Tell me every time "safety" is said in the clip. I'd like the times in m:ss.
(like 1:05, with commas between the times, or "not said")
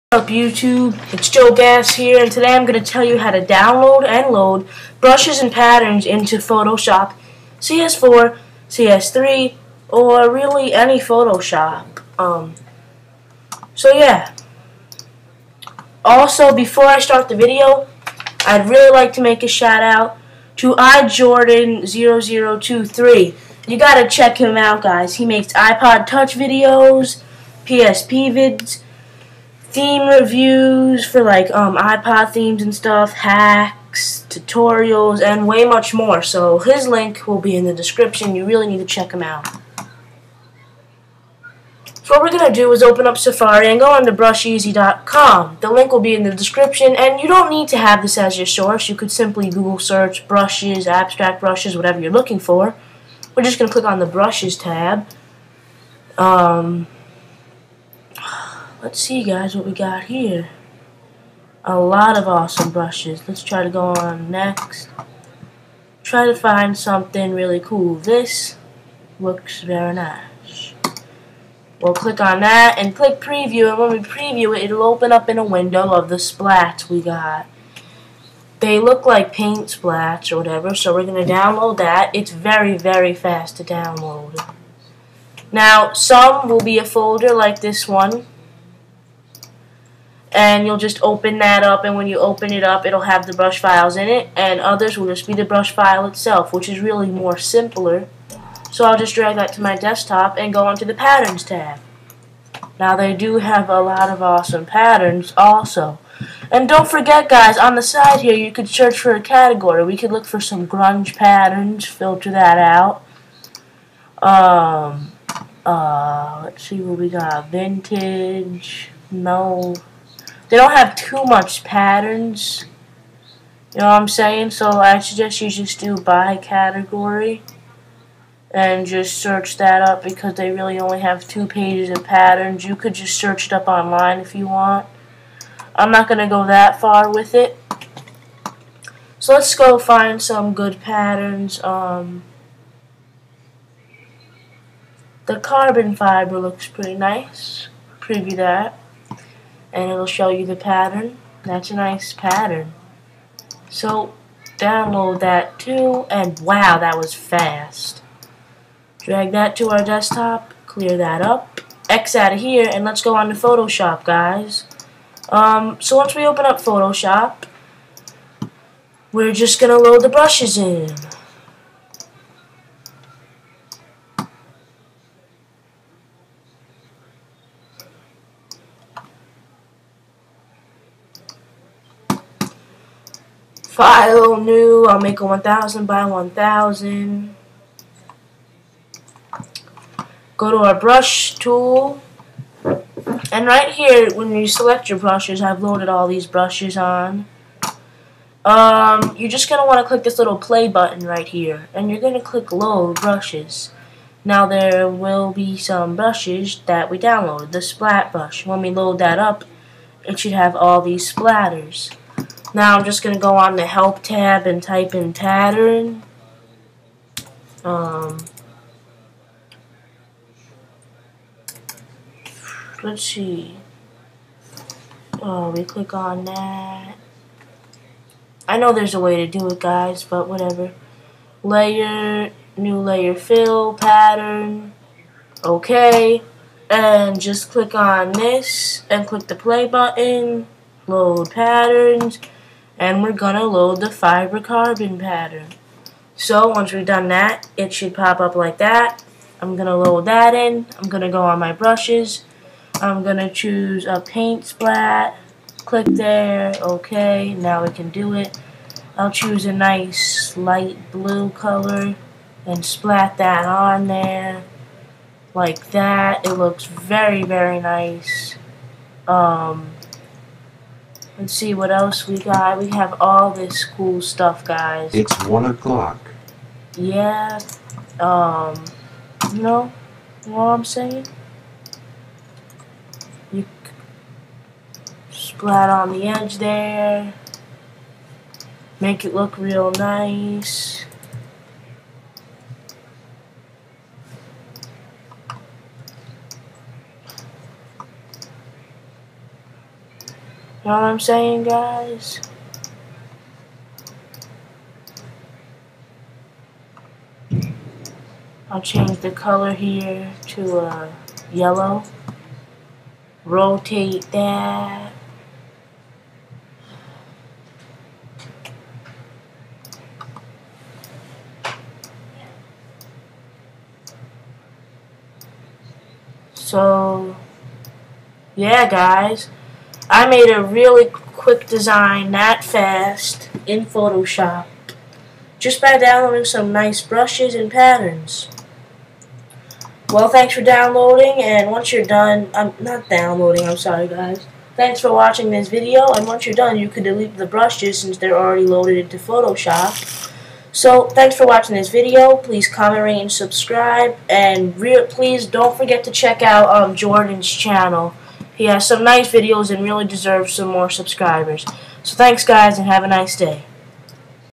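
not said.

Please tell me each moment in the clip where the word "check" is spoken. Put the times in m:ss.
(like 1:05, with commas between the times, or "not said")
0:24, 0:38, 5:55.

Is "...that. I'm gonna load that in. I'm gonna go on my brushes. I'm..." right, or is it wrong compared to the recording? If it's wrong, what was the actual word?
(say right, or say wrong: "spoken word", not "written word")
right.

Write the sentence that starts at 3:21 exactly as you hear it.
And you're going to click load brushes.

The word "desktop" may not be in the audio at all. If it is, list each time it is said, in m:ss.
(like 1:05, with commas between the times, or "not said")
1:39, 2:39.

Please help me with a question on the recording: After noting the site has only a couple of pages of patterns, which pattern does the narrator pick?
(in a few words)
carbon fiber.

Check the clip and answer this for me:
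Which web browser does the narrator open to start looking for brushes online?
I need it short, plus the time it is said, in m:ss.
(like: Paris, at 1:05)
Safari, at 0:43.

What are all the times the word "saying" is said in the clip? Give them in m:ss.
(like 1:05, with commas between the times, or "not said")
2:04, 4:40, 5:00.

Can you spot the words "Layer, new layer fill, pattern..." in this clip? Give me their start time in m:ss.
3:51.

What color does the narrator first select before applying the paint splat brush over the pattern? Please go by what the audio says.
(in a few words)
light blue.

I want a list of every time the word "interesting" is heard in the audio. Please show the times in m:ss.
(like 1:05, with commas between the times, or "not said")
not said.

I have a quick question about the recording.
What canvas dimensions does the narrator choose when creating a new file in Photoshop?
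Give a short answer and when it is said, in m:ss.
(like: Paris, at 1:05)
1000 by 1000, at 3:05.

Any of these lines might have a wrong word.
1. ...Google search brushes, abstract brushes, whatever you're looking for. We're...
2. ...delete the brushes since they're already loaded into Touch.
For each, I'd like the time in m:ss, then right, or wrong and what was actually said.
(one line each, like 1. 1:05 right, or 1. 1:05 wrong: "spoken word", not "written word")
1. 0:49 right
2. 5:46 wrong: "Photoshop", not "Touch".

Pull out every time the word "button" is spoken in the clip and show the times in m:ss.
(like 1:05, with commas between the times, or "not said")
3:20, 3:59.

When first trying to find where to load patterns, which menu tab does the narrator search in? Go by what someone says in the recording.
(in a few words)
help.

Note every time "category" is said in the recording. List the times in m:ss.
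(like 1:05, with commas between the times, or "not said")
1:49, 2:06.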